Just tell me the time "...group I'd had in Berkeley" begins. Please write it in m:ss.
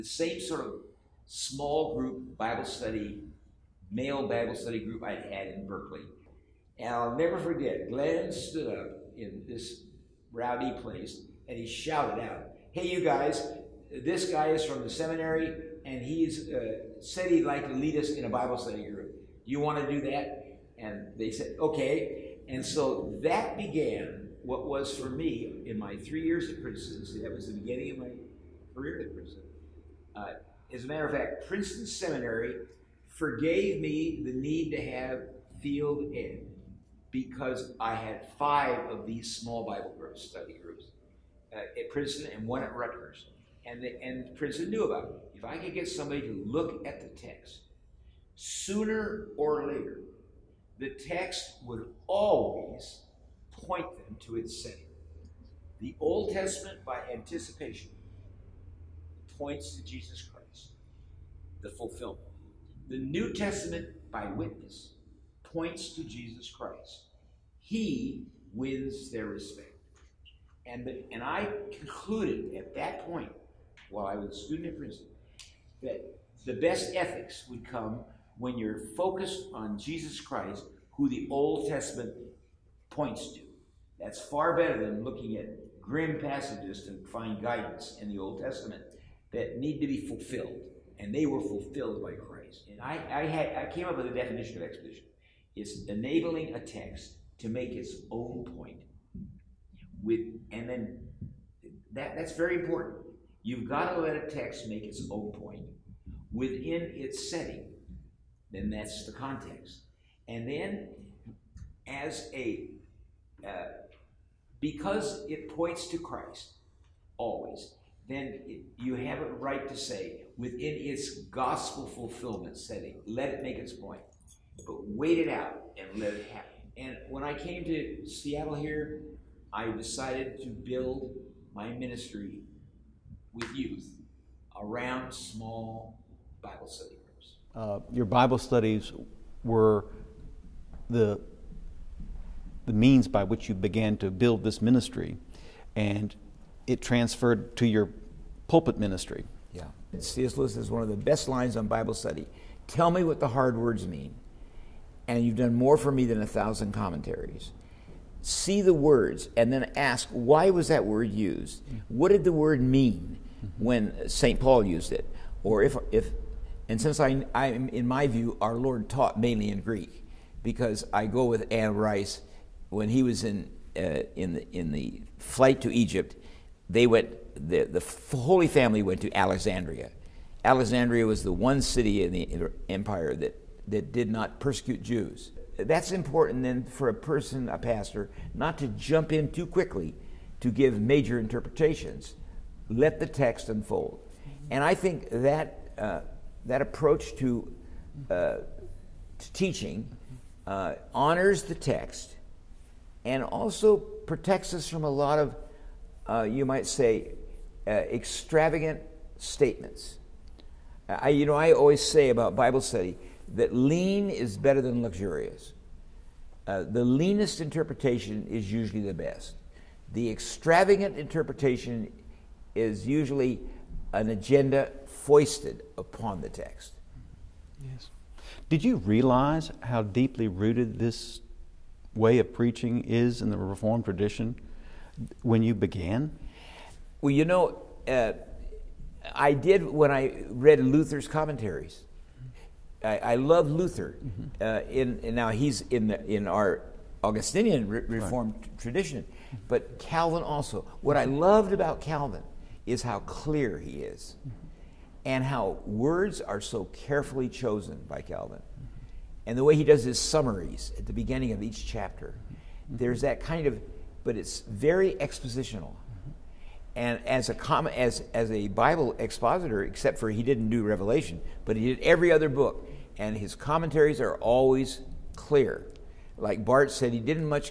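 0:04.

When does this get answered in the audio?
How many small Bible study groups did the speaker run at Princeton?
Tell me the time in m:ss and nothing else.
0:38.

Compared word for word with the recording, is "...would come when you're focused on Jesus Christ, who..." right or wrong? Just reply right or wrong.
right.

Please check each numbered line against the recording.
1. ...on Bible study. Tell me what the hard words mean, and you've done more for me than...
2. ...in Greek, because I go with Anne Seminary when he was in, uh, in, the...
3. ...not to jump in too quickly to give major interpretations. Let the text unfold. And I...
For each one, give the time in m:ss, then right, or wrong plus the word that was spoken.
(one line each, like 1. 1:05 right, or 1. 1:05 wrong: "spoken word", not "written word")
1. 2:31 right
2. 2:49 wrong: "Rice", not "Seminary"
3. 3:08 right.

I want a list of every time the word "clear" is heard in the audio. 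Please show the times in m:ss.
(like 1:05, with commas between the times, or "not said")
4:12, 4:35.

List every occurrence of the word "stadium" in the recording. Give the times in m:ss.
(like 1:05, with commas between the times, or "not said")
not said.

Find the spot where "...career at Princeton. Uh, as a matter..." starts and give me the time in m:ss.
0:28.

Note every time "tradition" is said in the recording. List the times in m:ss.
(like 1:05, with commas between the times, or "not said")
3:53, 4:08.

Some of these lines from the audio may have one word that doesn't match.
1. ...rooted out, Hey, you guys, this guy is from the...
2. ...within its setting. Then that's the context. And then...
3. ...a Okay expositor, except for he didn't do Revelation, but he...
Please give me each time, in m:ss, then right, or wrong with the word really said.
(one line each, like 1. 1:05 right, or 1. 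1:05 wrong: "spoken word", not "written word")
1. 0:11 wrong: "shouted", not "rooted"
2. 1:46 right
3. 4:28 wrong: "Bible", not "Okay".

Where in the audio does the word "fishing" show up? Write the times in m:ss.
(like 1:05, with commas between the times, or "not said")
not said.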